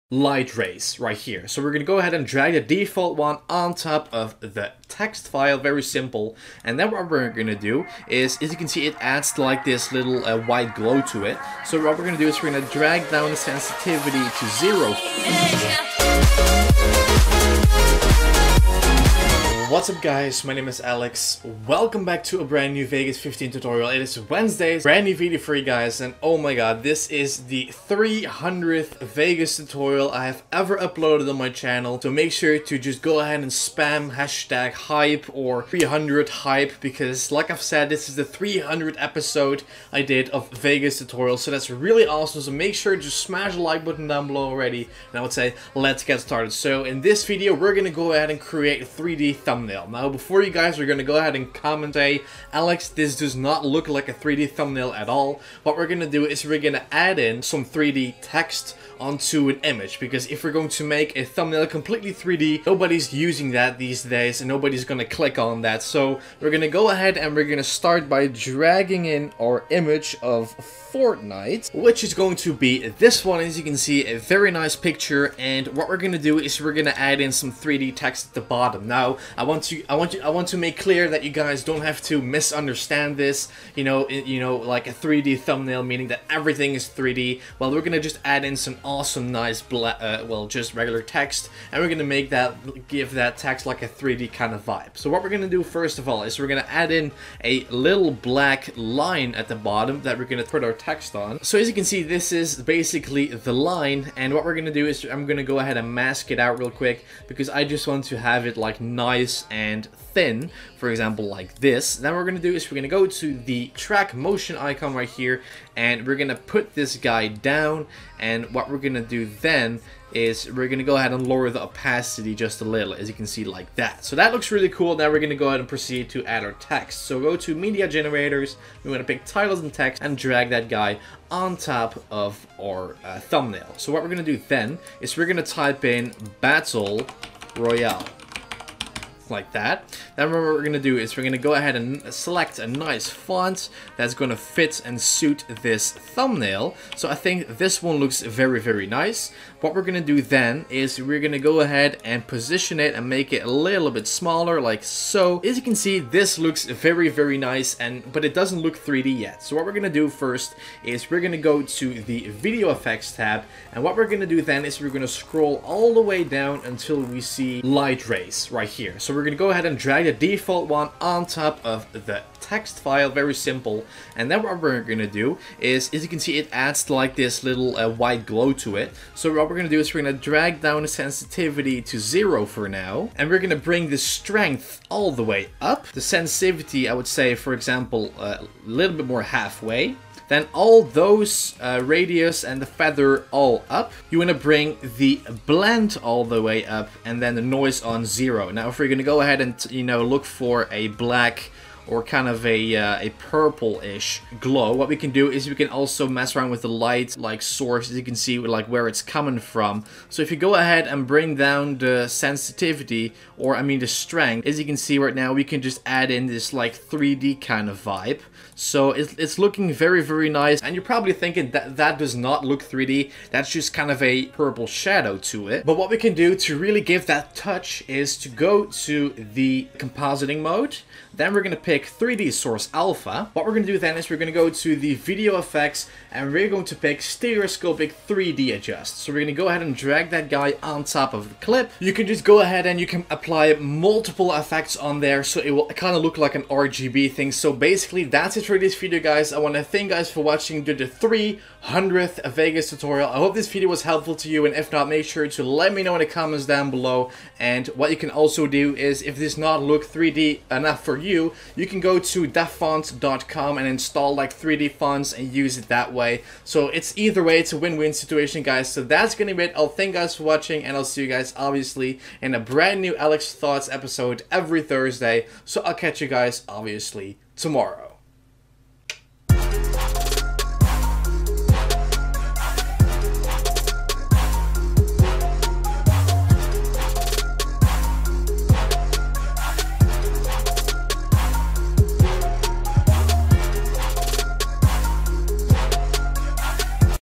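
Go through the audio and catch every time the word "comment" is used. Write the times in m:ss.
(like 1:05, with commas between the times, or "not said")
0:51, 4:16.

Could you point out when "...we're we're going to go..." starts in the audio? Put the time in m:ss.
2:49.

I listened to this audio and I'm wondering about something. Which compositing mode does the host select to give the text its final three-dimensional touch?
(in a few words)
3D Source Alpha.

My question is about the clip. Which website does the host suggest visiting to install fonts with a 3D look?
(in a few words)
dafonts.com.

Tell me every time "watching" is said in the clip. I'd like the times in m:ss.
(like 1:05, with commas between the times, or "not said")
4:10, 4:30.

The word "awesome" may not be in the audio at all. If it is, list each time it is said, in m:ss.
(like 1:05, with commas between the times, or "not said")
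0:42, 1:28.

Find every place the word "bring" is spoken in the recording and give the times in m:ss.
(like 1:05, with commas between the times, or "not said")
3:03, 3:14, 3:31.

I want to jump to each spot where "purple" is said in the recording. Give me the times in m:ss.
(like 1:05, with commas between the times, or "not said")
3:23, 3:44.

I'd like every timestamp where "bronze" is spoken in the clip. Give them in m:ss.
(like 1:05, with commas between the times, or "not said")
not said.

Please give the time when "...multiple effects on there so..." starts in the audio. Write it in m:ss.
4:03.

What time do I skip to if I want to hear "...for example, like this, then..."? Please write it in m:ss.
1:50.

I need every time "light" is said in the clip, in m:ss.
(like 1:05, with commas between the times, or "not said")
0:00, 2:47, 3:26.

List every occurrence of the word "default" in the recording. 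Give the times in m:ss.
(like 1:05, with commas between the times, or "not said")
0:02, 2:50.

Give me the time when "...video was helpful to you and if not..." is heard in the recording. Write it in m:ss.
4:13.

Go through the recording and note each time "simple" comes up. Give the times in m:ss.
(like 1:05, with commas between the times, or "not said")
0:05, 2:53.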